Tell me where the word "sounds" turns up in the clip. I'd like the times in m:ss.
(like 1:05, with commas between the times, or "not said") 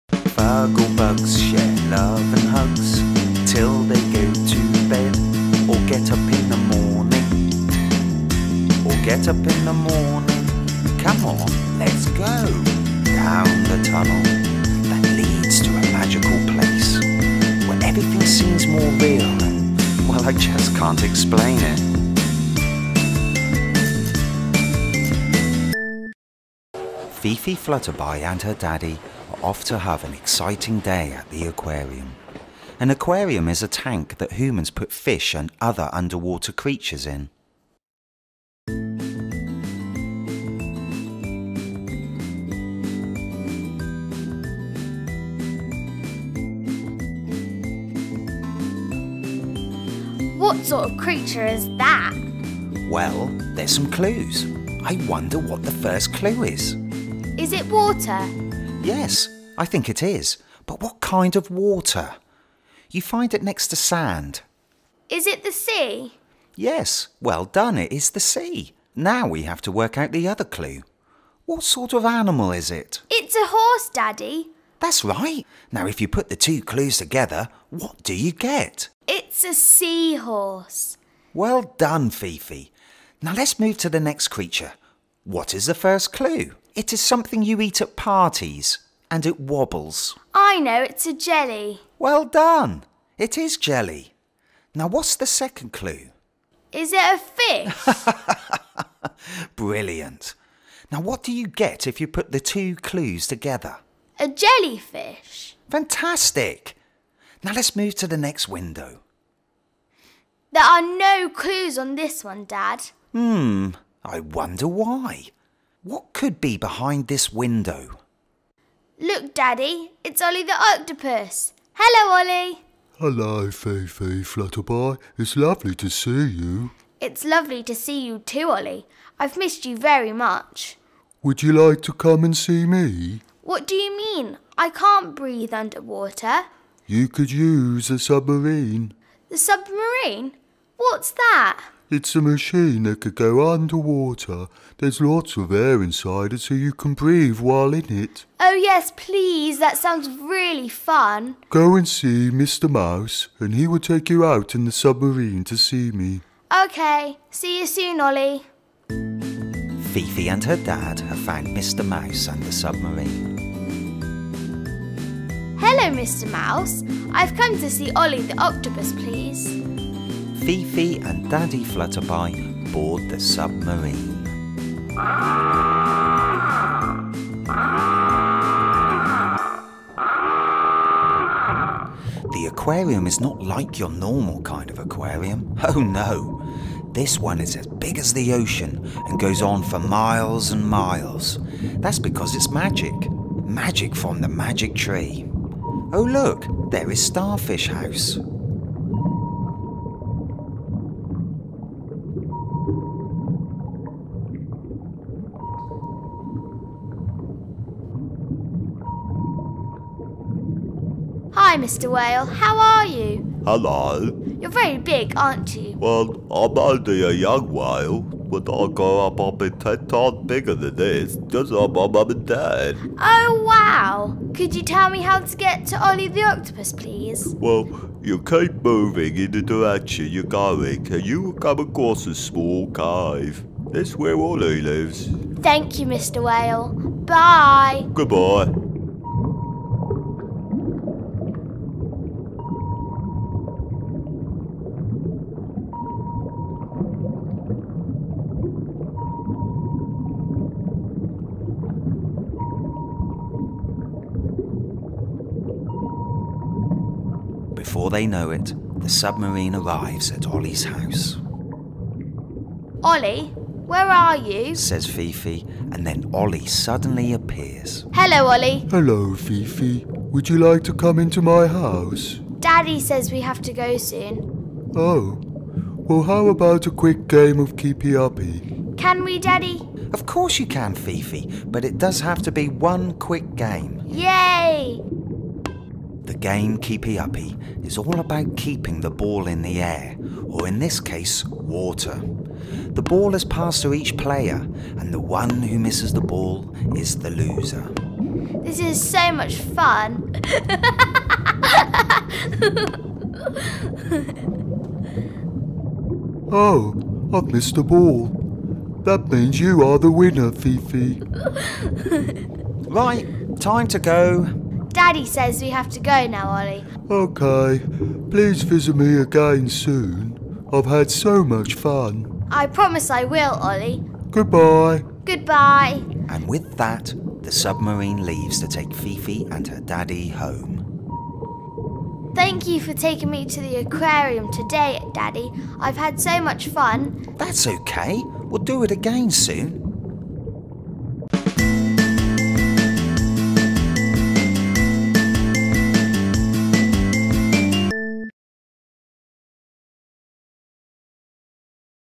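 2:29.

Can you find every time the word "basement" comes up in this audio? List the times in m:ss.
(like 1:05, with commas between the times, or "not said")
not said.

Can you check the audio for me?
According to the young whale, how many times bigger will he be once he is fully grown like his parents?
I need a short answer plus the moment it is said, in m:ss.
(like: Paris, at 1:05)
10 times, at 3:39.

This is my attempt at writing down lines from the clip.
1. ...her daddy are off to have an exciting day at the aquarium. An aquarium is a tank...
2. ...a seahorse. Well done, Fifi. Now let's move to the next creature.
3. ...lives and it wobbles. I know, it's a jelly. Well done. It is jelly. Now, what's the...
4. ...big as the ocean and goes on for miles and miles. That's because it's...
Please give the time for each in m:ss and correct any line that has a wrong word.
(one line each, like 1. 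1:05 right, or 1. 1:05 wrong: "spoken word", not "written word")
1. 0:28 right
2. 1:19 right
3. 1:27 wrong: "parties", not "lives"
4. 3:07 right.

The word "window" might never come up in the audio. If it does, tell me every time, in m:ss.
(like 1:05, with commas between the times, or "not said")
1:48, 1:57.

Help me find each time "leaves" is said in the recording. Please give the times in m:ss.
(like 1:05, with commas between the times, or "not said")
5:28.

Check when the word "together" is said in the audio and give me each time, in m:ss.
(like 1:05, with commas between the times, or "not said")
1:16, 1:43.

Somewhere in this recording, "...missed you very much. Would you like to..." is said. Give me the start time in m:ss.
2:09.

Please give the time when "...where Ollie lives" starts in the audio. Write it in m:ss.
3:53.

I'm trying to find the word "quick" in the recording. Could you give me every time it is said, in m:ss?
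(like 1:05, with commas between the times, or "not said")
4:36, 4:42.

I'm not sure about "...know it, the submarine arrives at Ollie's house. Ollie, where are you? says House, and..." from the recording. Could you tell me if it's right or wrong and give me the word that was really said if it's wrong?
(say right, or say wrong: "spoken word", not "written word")
wrong: "Fifi", not "House".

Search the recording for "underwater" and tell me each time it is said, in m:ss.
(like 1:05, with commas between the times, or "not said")
0:35, 2:15, 2:23.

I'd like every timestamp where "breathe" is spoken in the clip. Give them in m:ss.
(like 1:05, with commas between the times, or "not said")
2:15, 2:26.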